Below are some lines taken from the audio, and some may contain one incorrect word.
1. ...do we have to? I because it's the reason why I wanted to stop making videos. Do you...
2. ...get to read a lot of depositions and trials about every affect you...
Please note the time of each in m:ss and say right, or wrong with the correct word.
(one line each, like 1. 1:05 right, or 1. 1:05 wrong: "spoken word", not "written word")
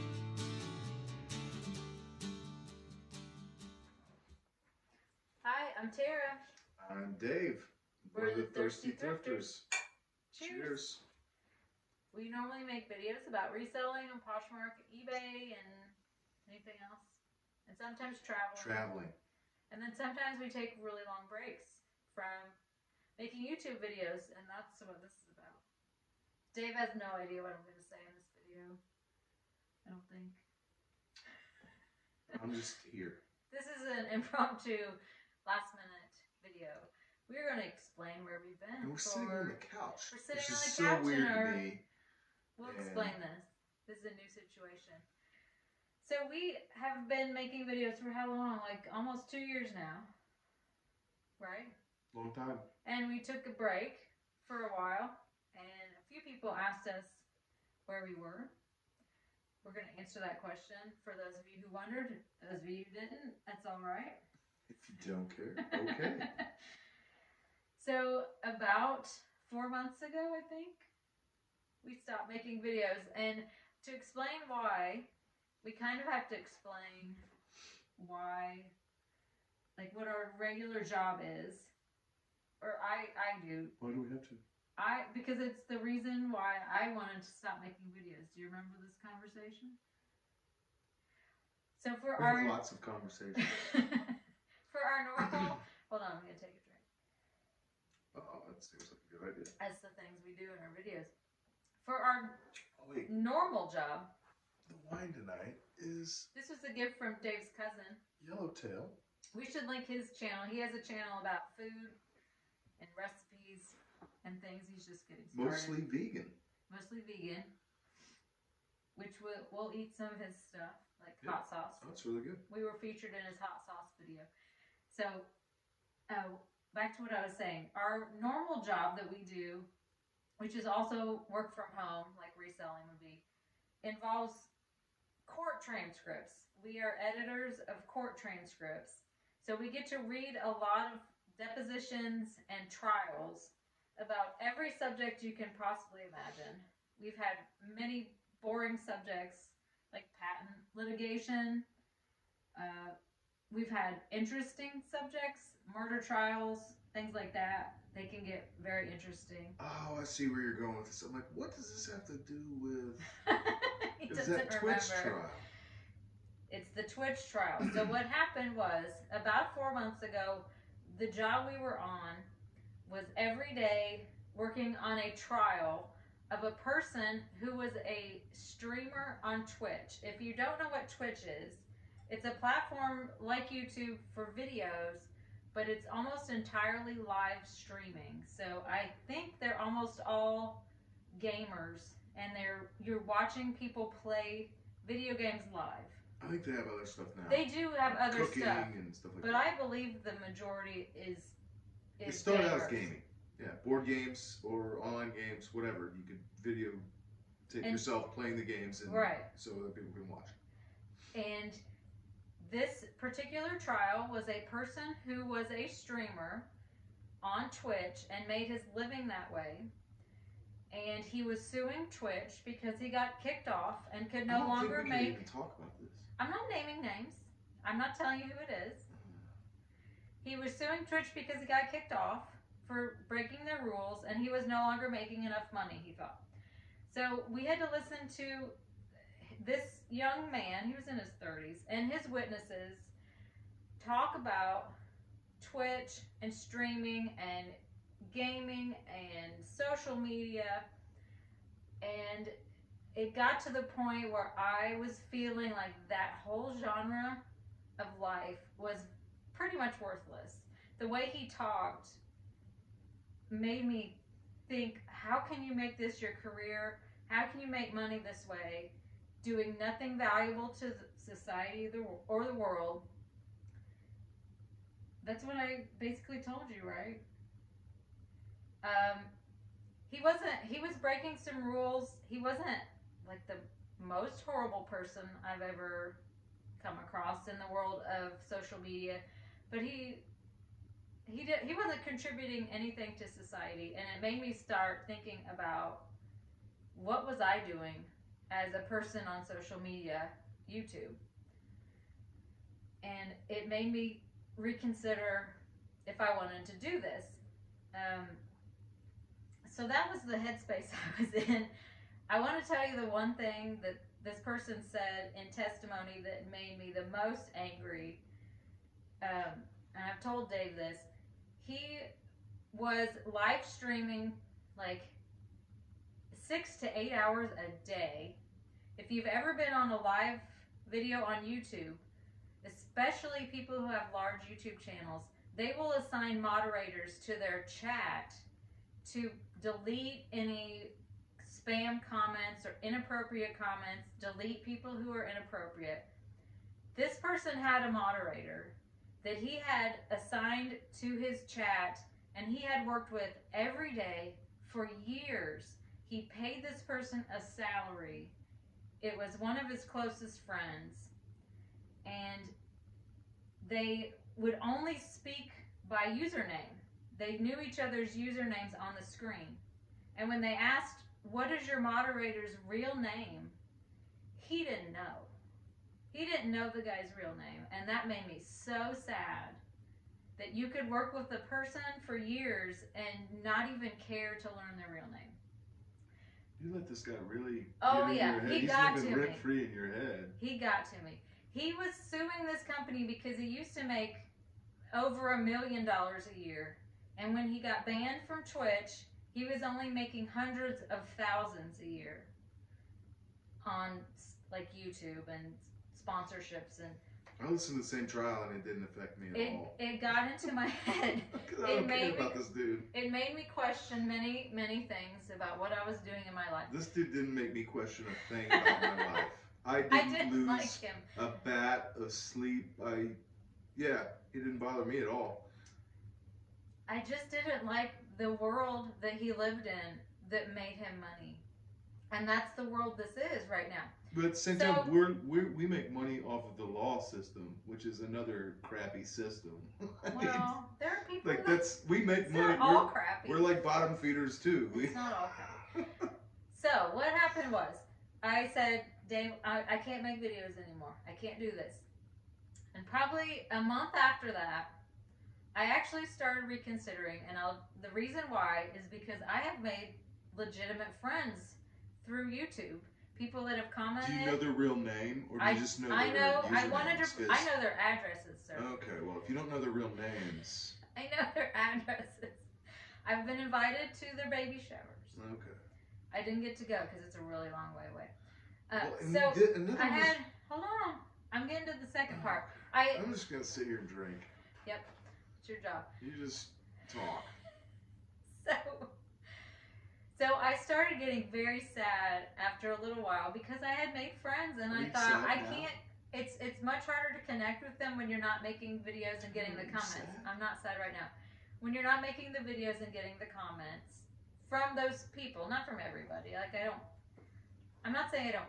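1. 1:23 right
2. 2:19 wrong: "subject", not "affect".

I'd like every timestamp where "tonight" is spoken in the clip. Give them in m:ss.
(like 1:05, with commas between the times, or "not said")
1:45.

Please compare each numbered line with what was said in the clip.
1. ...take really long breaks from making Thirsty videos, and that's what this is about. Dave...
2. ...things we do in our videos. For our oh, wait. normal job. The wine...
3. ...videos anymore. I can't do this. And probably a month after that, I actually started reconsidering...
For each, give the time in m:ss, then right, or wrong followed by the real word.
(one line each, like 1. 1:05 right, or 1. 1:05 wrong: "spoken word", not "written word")
1. 0:20 wrong: "YouTube", not "Thirsty"
2. 1:39 right
3. 7:30 right.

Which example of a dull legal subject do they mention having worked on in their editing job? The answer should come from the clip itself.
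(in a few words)
patent litigation.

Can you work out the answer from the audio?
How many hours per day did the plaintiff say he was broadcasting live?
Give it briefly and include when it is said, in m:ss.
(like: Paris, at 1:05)
6 to 8 hours, at 5:26.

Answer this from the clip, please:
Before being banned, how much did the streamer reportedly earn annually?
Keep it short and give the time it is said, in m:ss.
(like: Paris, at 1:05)
over a million dollars, at 6:34.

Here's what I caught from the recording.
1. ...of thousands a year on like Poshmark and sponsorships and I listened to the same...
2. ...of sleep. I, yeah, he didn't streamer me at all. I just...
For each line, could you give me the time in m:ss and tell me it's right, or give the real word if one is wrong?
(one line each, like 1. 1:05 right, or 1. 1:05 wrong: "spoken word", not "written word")
1. 6:40 wrong: "YouTube", not "Poshmark"
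2. 7:01 wrong: "bother", not "streamer".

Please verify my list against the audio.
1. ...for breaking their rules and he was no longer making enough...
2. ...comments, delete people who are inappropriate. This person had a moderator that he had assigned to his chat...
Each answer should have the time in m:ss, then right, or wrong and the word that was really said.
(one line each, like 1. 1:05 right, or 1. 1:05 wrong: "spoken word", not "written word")
1. 3:52 right
2. 5:43 right.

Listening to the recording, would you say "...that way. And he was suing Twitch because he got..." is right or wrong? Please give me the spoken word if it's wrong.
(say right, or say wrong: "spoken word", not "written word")
right.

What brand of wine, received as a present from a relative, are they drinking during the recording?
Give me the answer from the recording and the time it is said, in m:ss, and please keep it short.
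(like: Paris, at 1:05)
Yellowtail, at 1:48.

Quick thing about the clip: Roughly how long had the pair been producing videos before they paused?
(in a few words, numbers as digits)
almost two years.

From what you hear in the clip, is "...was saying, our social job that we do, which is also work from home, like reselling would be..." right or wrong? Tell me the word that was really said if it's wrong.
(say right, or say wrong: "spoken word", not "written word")
wrong: "normal", not "social".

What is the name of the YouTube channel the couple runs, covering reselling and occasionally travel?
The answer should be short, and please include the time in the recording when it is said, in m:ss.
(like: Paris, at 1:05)
Thirsty Thrifters, at 0:08.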